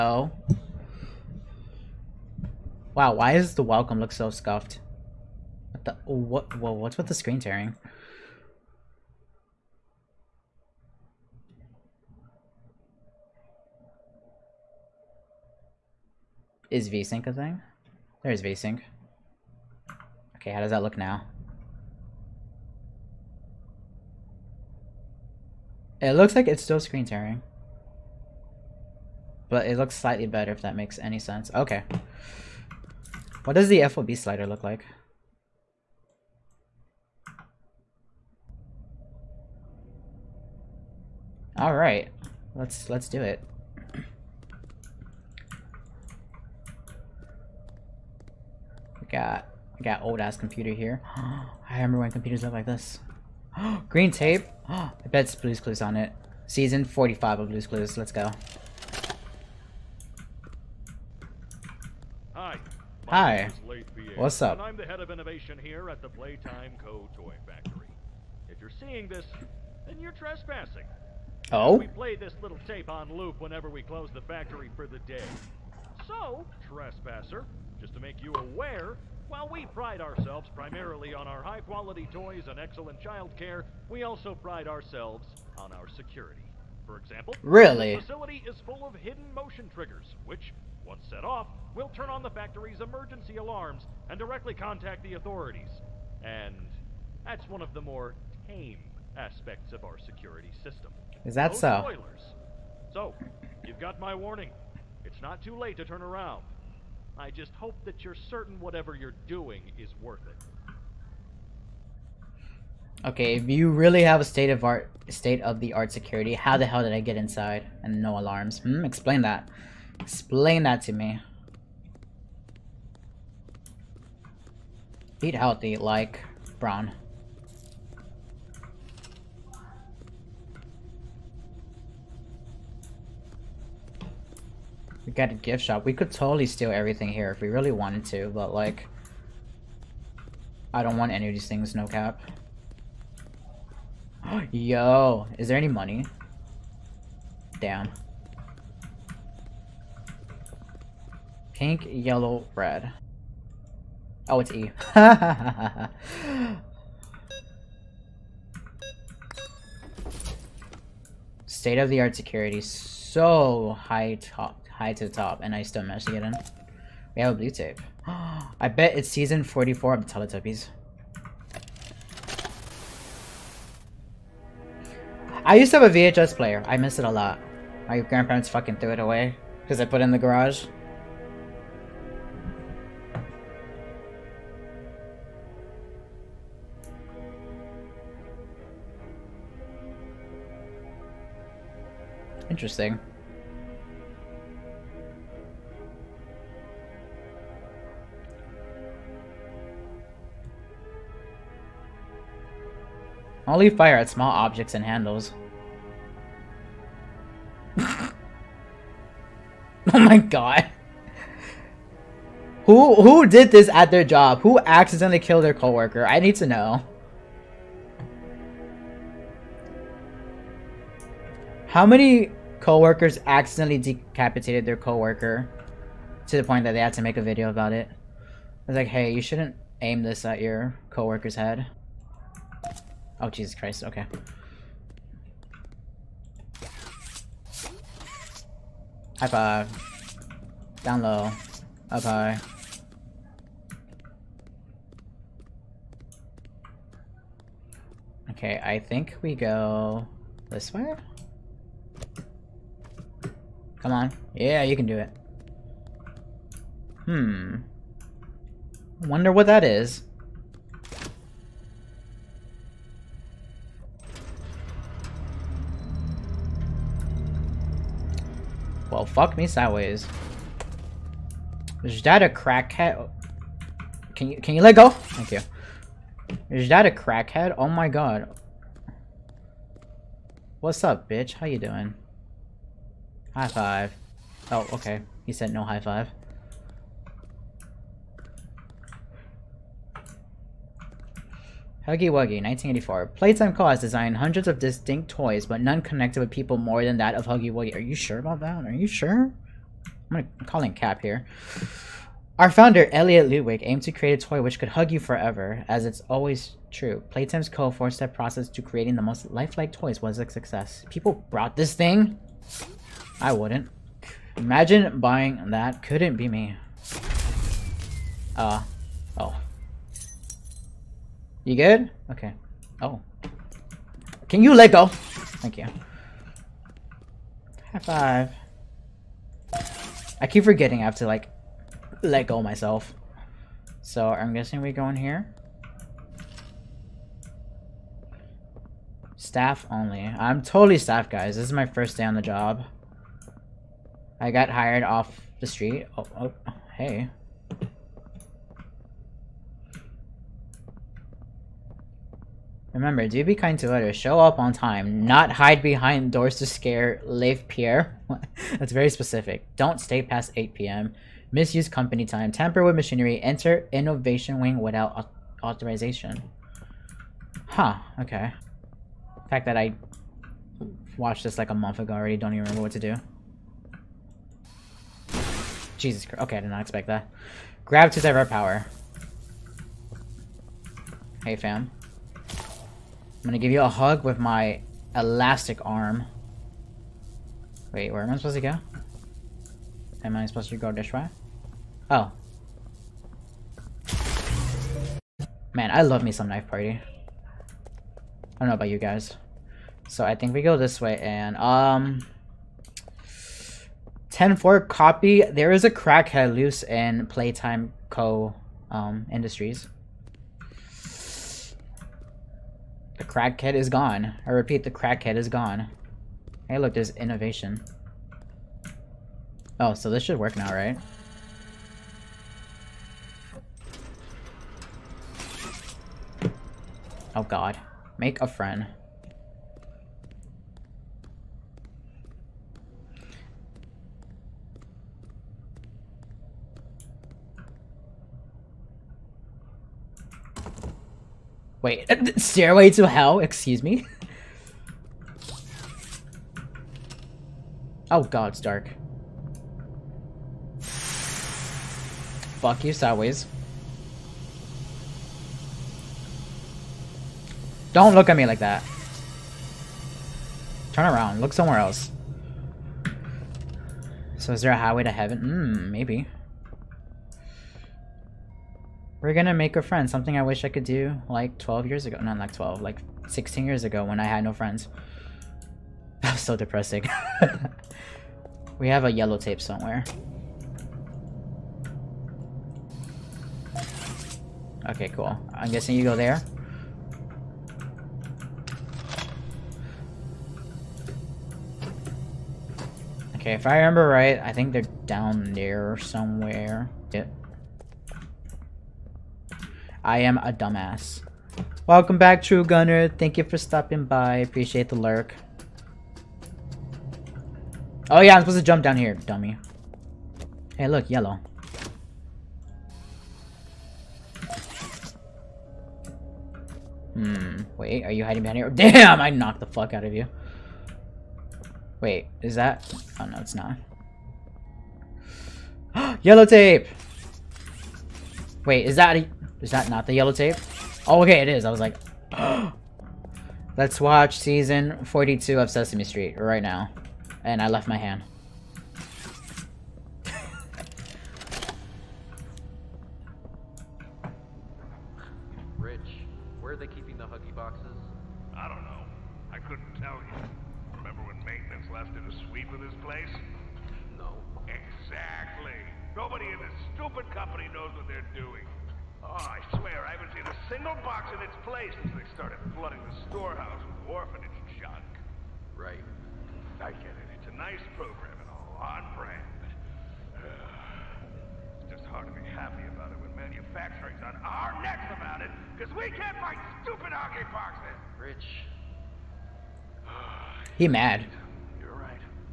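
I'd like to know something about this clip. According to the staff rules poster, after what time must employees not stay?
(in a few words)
8 p.m.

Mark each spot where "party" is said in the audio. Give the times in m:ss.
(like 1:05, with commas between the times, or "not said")
6:36.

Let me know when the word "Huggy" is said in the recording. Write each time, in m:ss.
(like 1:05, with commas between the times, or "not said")
4:51, 4:57.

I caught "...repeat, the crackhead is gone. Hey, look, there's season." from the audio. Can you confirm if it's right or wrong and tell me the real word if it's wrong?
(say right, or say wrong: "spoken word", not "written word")
wrong: "innovation", not "season".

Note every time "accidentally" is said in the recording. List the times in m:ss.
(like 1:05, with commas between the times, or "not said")
3:34, 3:43.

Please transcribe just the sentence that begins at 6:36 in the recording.
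I don't know about you guys.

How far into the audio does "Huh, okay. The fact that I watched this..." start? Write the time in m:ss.
6:07.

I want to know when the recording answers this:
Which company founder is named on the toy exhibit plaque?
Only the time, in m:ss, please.
5:02.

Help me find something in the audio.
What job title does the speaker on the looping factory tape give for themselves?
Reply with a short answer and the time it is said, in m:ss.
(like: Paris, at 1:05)
Head of innovation, at 1:04.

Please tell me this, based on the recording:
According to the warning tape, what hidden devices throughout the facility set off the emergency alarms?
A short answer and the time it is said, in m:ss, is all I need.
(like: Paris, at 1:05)
Motion triggers, at 1:28.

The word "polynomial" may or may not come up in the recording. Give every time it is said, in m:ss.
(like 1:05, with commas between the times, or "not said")
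not said.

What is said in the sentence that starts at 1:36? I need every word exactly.
And that's one of the more tame aspects of our security system.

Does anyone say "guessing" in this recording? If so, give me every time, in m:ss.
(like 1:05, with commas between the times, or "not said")
5:34, 8:05.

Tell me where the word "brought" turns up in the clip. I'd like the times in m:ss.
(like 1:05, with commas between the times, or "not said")
5:11.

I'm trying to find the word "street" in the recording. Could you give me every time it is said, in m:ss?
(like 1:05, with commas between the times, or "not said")
5:45, 8:55.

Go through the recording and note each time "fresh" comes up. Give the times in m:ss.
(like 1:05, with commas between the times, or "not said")
not said.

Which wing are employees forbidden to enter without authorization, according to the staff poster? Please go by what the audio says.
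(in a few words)
Innovation wing.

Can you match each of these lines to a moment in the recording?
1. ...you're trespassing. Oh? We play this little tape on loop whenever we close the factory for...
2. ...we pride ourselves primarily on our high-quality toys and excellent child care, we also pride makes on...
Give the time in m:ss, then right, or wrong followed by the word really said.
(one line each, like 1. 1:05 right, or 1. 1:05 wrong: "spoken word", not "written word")
1. 1:09 right
2. 1:19 wrong: "ourselves", not "makes".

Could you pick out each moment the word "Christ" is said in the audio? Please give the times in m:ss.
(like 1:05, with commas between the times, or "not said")
3:53, 6:16.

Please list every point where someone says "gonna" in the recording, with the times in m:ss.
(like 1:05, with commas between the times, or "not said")
5:00, 6:23, 7:49.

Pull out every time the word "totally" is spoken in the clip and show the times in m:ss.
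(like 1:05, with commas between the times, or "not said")
2:16, 5:40.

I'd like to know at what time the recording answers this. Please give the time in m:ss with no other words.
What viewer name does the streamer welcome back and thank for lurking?
8:22.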